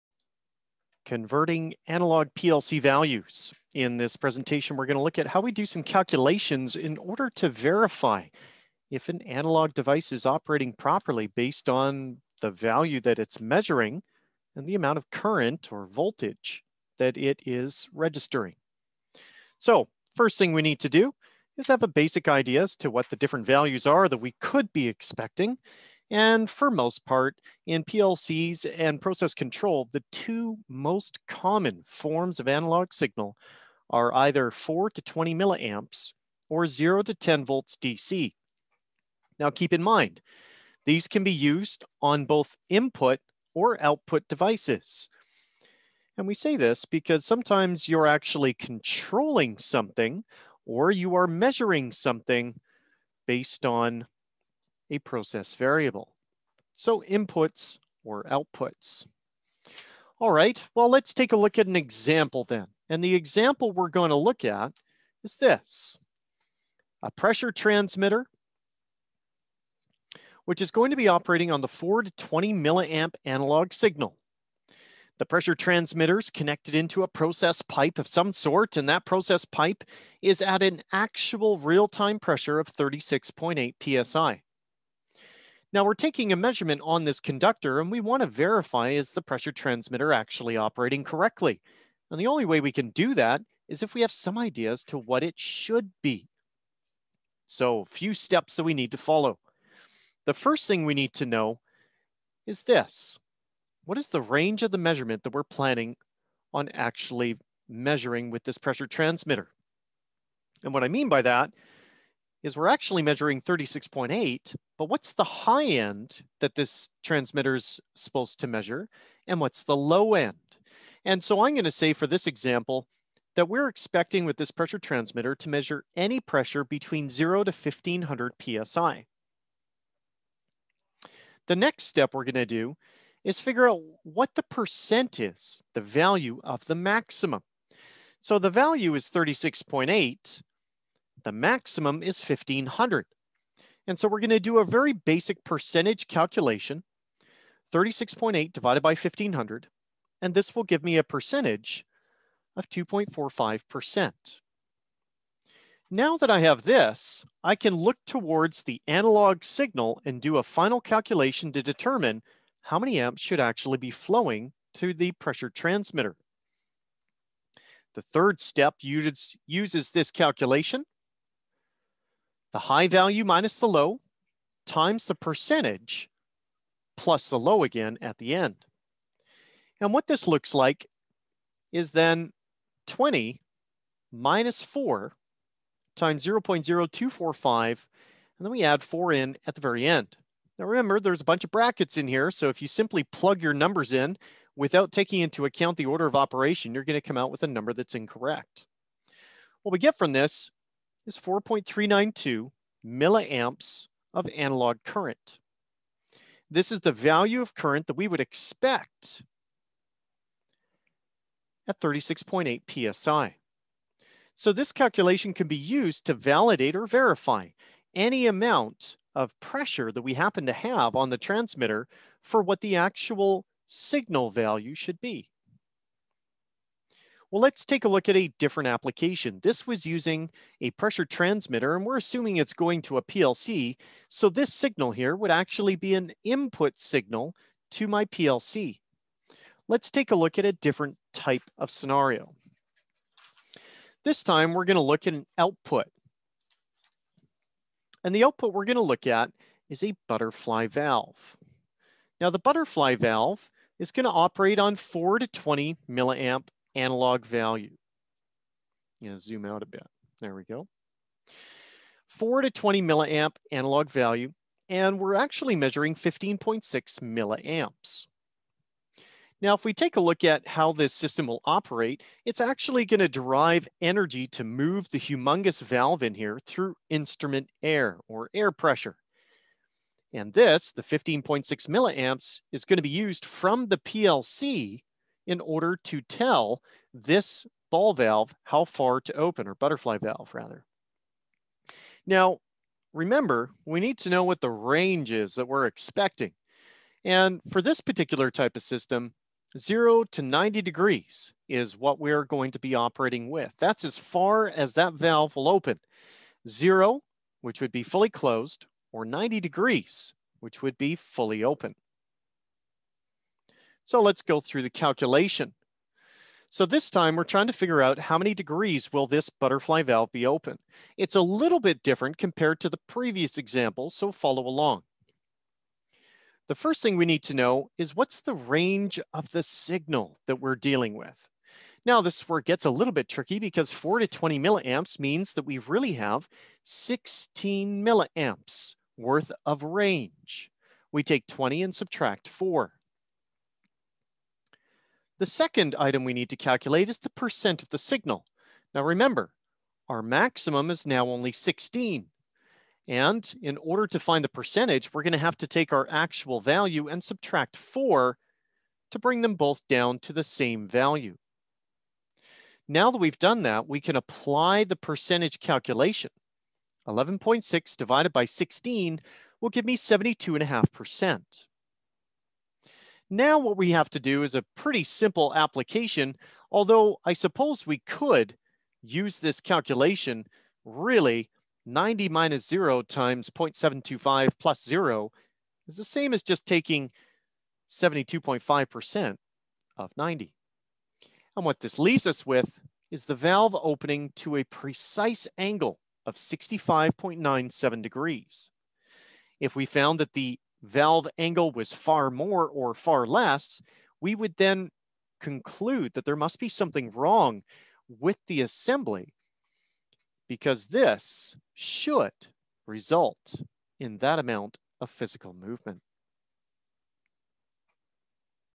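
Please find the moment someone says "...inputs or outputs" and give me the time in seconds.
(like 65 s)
57 s.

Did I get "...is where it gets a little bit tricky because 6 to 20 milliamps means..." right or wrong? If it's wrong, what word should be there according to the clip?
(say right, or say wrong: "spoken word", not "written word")
wrong: "4", not "6".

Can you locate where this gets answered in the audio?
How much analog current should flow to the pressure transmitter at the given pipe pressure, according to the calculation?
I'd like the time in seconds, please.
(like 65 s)
201 s.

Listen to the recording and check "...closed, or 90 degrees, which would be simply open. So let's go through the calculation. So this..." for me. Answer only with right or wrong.
wrong.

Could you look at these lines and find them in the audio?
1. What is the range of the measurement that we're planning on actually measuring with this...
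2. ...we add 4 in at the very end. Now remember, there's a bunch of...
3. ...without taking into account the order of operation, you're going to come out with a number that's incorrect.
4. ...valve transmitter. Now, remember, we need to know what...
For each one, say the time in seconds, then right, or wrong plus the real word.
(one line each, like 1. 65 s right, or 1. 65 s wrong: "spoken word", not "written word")
1. 103 s right
2. 188 s right
3. 194 s right
4. 289 s wrong: "rather", not "transmitter".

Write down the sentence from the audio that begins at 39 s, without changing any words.
Now keep in mind, these can be used on both input or output devices.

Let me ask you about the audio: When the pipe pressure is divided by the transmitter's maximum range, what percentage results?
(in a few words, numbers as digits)
2.45%.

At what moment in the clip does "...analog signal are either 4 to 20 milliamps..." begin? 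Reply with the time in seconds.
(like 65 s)
32 s.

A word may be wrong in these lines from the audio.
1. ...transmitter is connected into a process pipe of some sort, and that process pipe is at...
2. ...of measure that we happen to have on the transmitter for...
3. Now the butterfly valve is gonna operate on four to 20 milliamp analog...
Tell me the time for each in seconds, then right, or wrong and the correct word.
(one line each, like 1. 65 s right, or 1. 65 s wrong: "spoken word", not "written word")
1. 75 s right
2. 219 s wrong: "pressure", not "measure"
3. 252 s right.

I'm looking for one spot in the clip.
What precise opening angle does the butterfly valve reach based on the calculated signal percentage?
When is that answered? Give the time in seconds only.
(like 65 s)
396 s.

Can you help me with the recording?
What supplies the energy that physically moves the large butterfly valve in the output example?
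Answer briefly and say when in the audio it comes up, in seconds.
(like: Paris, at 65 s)
Instrument air, at 276 s.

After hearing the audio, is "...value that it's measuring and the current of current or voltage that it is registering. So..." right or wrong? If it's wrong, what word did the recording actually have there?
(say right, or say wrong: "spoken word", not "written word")
wrong: "amount", not "current".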